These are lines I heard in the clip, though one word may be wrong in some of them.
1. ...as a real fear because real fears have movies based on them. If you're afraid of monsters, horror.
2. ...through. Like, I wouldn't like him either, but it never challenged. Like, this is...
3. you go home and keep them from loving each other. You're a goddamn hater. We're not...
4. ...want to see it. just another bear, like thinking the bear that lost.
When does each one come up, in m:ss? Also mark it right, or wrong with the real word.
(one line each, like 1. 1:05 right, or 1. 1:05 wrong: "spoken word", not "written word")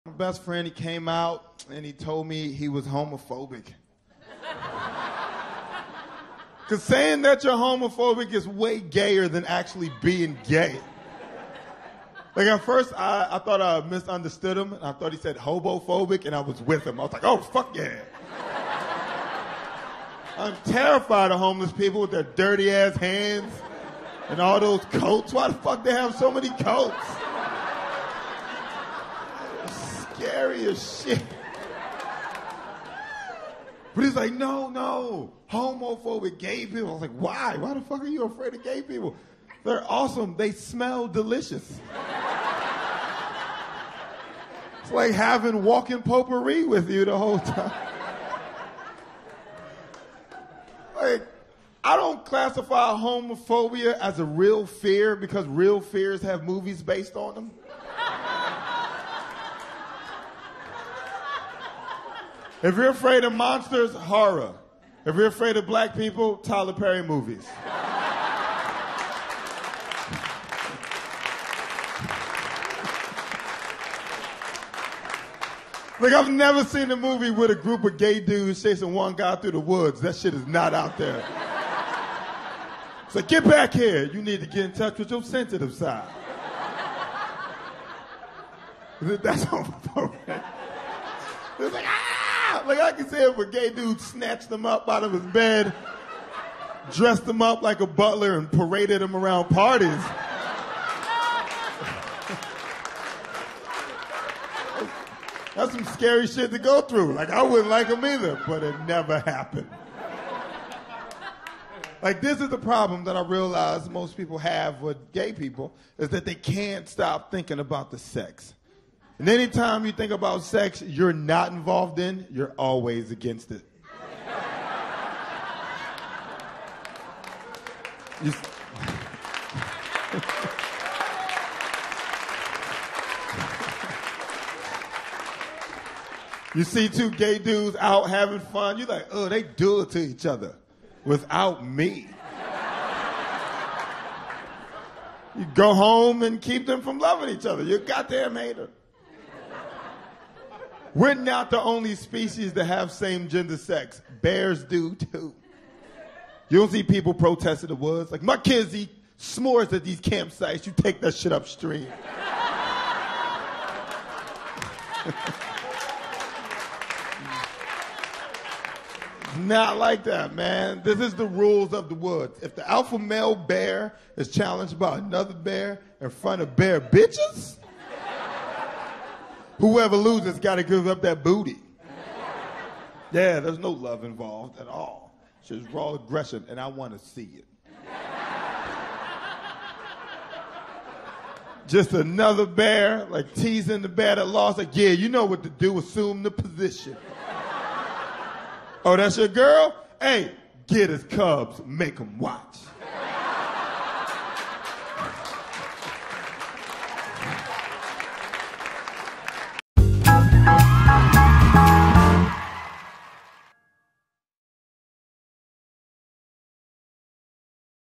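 1. 0:53 right
2. 1:46 wrong: "happened", not "challenged"
3. 2:25 right
4. 3:06 wrong: "teasing", not "thinking".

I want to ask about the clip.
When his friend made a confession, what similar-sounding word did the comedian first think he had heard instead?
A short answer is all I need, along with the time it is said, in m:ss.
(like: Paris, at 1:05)
hobophobic, at 0:15.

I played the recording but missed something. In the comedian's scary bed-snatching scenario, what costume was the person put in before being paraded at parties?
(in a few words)
a butler.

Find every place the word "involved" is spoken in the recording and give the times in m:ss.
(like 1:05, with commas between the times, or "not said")
2:01, 3:04.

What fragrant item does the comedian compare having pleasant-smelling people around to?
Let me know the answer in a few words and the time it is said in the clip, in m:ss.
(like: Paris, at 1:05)
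walking potpourri, at 0:45.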